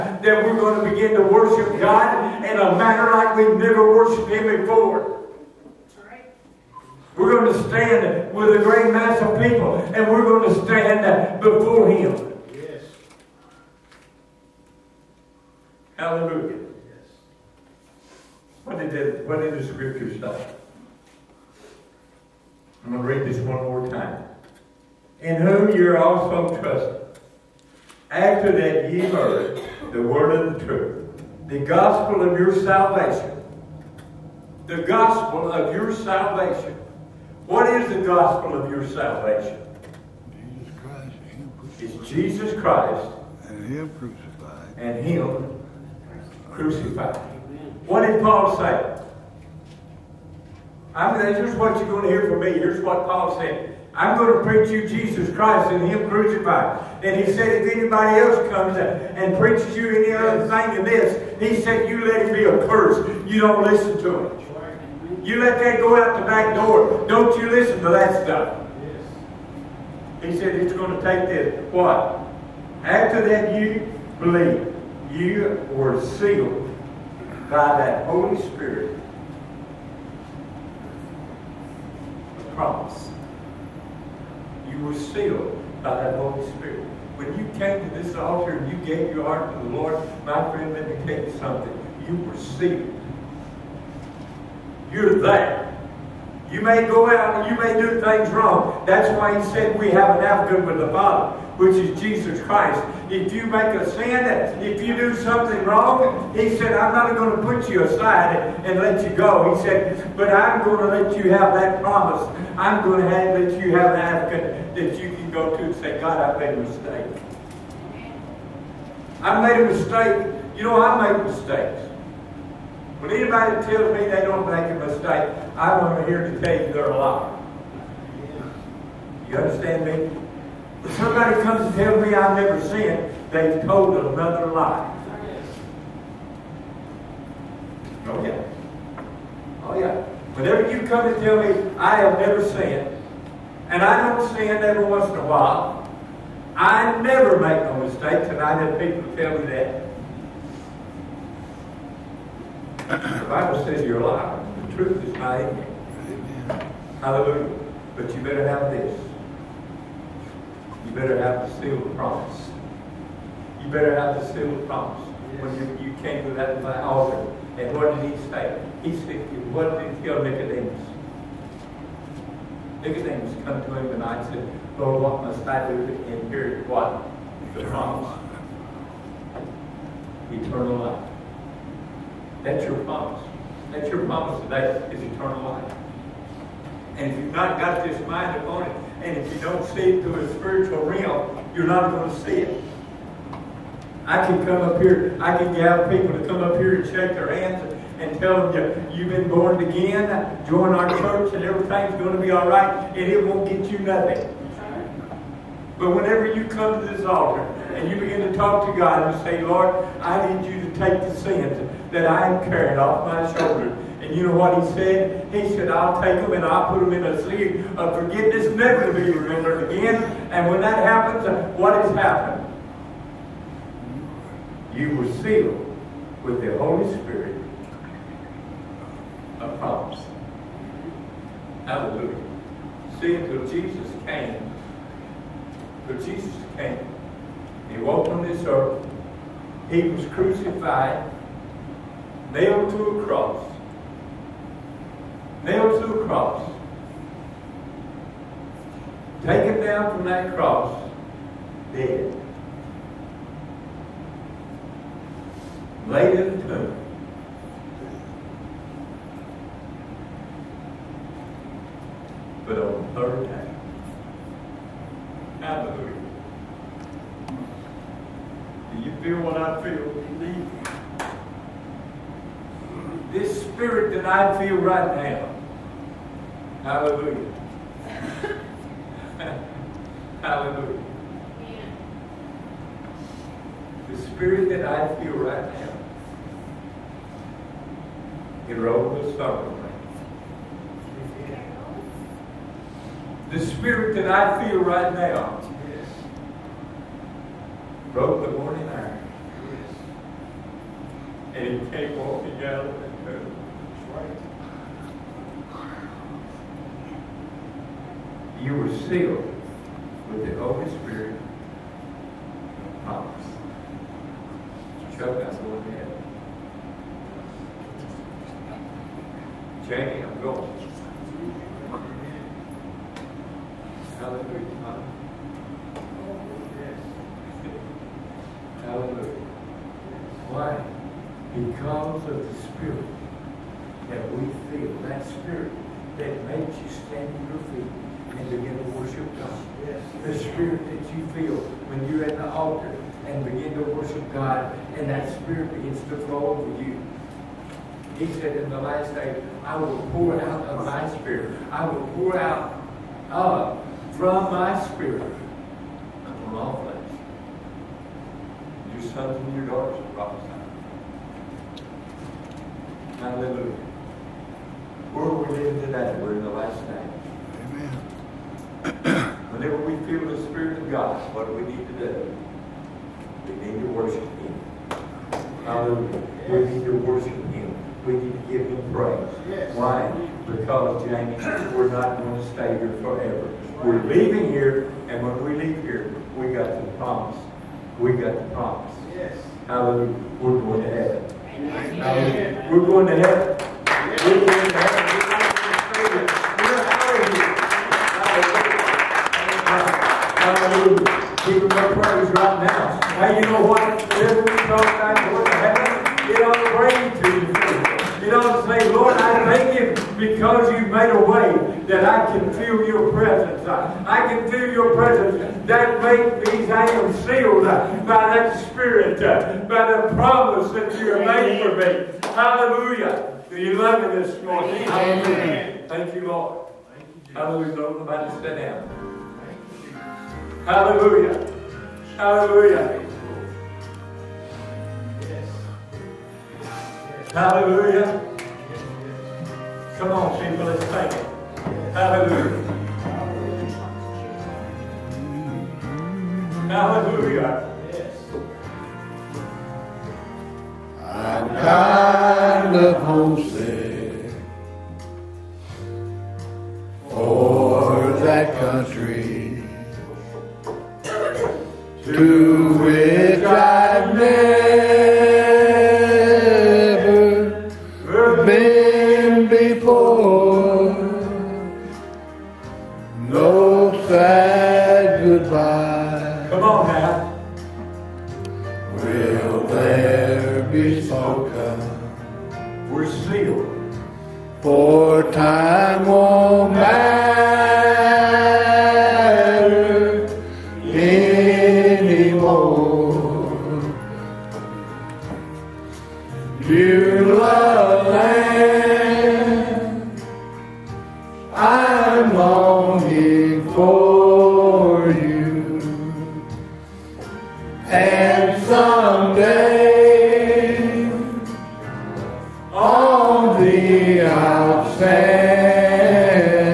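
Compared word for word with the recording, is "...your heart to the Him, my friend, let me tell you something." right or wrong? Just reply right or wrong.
wrong.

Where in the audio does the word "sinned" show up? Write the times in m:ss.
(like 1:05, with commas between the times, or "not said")
2:12, 2:22.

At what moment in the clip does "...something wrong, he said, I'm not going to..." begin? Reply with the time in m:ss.
1:45.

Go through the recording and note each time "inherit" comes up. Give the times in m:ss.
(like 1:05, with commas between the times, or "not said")
2:56.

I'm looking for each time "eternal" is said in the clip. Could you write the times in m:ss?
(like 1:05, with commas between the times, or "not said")
3:00, 3:05.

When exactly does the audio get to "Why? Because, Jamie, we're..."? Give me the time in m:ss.
6:19.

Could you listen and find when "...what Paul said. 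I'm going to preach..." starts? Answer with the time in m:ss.
0:52.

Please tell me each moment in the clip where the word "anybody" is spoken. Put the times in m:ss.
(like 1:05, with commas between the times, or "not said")
0:57, 2:03.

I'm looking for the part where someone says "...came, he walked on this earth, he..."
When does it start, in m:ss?
3:56.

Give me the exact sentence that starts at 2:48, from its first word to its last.
He said, what did he tell Nicodemus?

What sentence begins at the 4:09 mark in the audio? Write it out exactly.
Taken down from that cross, dead.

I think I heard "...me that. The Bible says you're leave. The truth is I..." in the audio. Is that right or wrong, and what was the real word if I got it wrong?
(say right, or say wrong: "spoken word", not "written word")
wrong: "alive", not "leave".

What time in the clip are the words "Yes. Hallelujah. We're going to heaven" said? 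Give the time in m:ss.
6:28.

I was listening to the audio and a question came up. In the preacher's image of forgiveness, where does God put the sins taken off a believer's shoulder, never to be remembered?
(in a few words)
A sleeve of forgiveness.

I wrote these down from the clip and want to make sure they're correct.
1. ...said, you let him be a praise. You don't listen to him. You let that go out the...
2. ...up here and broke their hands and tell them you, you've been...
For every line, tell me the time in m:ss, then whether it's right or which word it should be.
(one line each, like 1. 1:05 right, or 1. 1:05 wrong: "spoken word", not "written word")
1. 1:01 wrong: "curse", not "praise"
2. 3:16 wrong: "shake", not "broke".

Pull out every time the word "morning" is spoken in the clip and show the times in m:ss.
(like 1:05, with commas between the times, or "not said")
4:58, 7:04.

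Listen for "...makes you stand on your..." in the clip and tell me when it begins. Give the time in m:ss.
5:36.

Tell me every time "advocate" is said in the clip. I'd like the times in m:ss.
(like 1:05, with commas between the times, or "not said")
1:40, 1:54.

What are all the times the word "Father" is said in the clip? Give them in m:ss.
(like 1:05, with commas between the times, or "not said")
1:40.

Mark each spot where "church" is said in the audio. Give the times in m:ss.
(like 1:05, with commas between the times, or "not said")
3:20.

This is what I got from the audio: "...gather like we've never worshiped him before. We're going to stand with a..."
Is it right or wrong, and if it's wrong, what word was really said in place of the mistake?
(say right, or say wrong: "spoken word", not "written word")
wrong: "manner", not "gather".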